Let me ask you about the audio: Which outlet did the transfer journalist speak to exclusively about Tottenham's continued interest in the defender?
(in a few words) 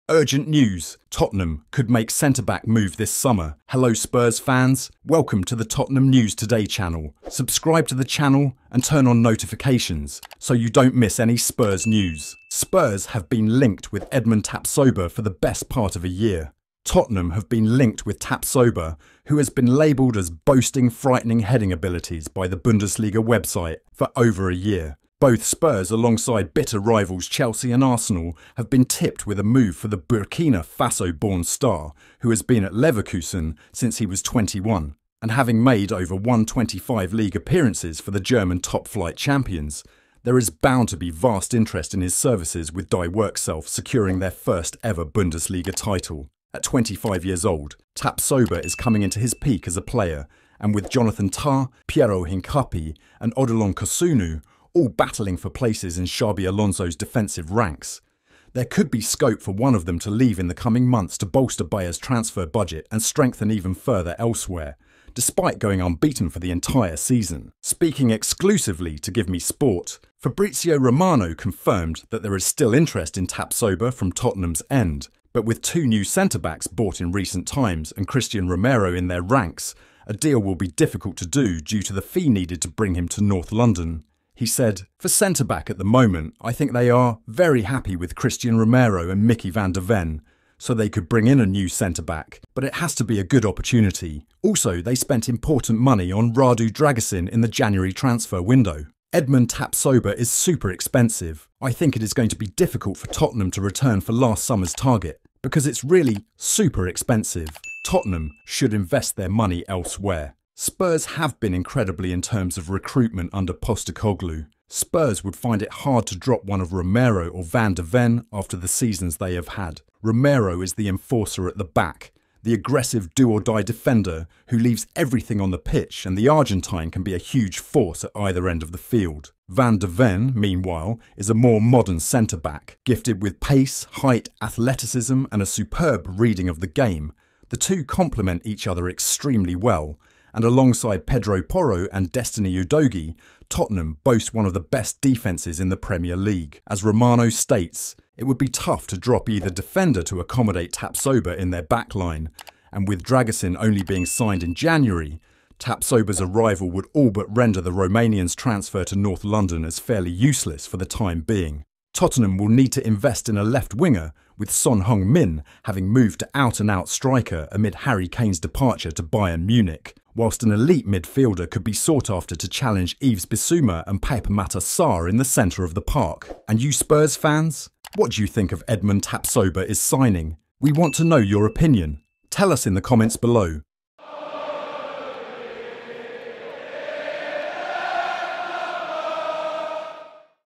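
Give Me Sport.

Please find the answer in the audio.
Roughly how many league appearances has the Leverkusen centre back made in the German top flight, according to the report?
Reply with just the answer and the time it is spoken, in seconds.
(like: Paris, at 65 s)
Over 125, at 35 s.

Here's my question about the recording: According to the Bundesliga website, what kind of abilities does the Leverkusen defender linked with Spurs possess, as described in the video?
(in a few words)
Frightening heading abilities.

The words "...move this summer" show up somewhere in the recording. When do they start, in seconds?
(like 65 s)
2 s.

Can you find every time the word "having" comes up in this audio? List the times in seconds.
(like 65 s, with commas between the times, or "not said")
35 s, 165 s.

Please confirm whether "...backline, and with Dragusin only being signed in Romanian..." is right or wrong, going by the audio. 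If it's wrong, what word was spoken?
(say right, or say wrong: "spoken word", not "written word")
wrong: "January", not "Romanian".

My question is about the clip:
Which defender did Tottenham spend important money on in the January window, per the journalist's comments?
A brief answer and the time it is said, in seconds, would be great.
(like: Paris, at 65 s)
Radu Dragusin, at 96 s.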